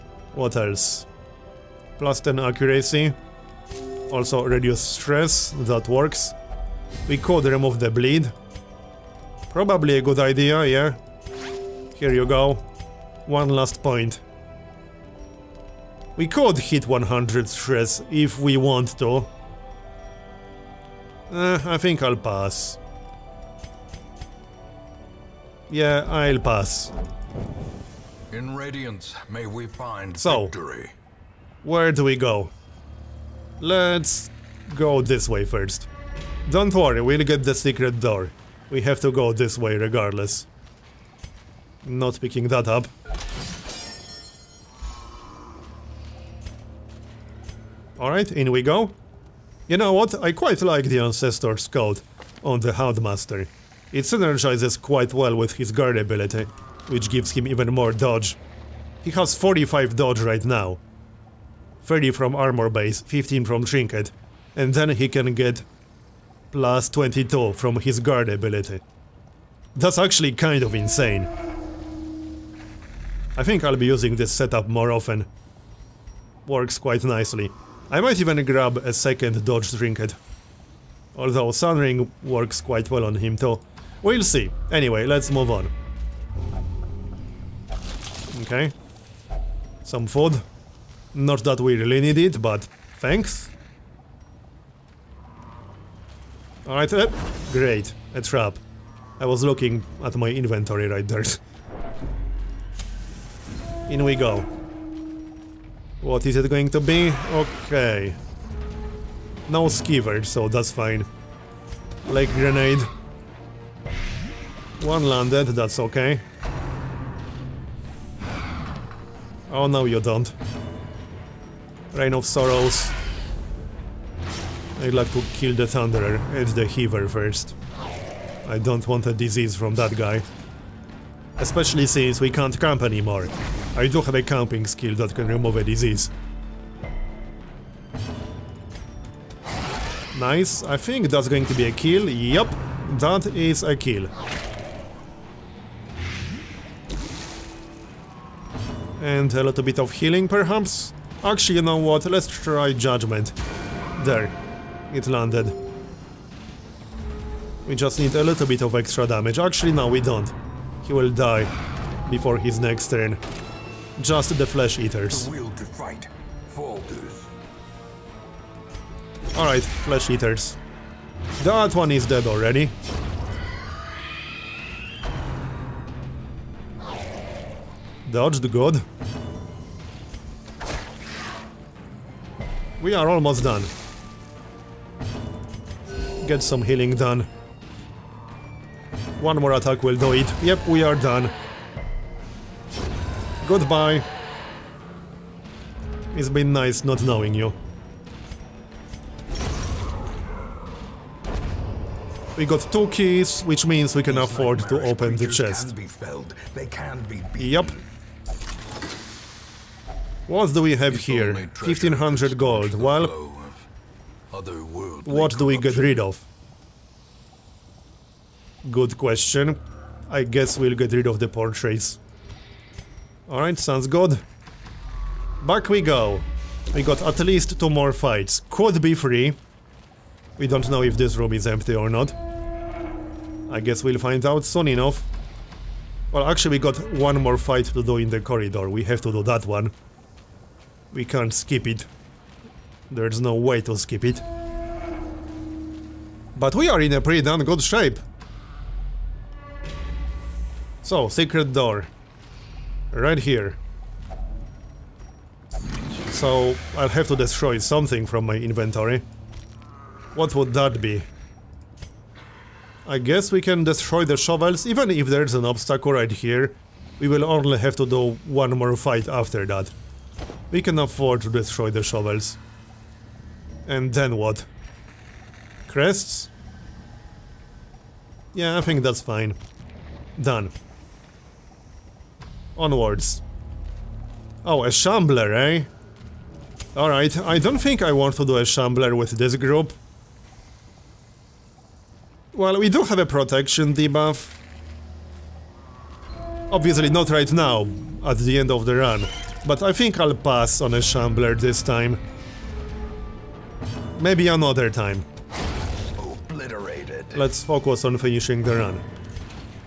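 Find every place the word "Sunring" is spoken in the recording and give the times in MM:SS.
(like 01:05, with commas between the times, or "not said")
01:21.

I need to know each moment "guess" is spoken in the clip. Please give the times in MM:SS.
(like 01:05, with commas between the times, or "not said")
03:40, 03:53, 04:22.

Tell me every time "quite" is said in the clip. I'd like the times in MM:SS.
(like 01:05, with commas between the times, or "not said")
00:50, 00:54, 01:16, 01:22.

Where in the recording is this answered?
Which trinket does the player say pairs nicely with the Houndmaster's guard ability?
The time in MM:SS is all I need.
00:50.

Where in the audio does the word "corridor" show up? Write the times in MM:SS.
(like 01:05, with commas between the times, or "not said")
03:58.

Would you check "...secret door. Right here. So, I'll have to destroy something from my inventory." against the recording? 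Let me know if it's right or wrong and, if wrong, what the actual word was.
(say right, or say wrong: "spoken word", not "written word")
right.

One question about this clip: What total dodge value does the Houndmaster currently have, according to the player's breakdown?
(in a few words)
45.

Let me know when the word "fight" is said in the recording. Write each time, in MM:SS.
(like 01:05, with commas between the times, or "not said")
03:47, 03:57, 04:28.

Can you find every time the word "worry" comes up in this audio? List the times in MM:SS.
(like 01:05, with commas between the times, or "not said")
00:36.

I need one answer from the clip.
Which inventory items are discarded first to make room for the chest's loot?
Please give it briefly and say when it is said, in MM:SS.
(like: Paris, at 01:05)
portraits, at 03:41.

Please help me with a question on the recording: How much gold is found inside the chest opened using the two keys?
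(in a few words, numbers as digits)
1500.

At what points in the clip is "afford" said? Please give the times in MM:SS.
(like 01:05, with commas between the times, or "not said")
03:24, 04:30.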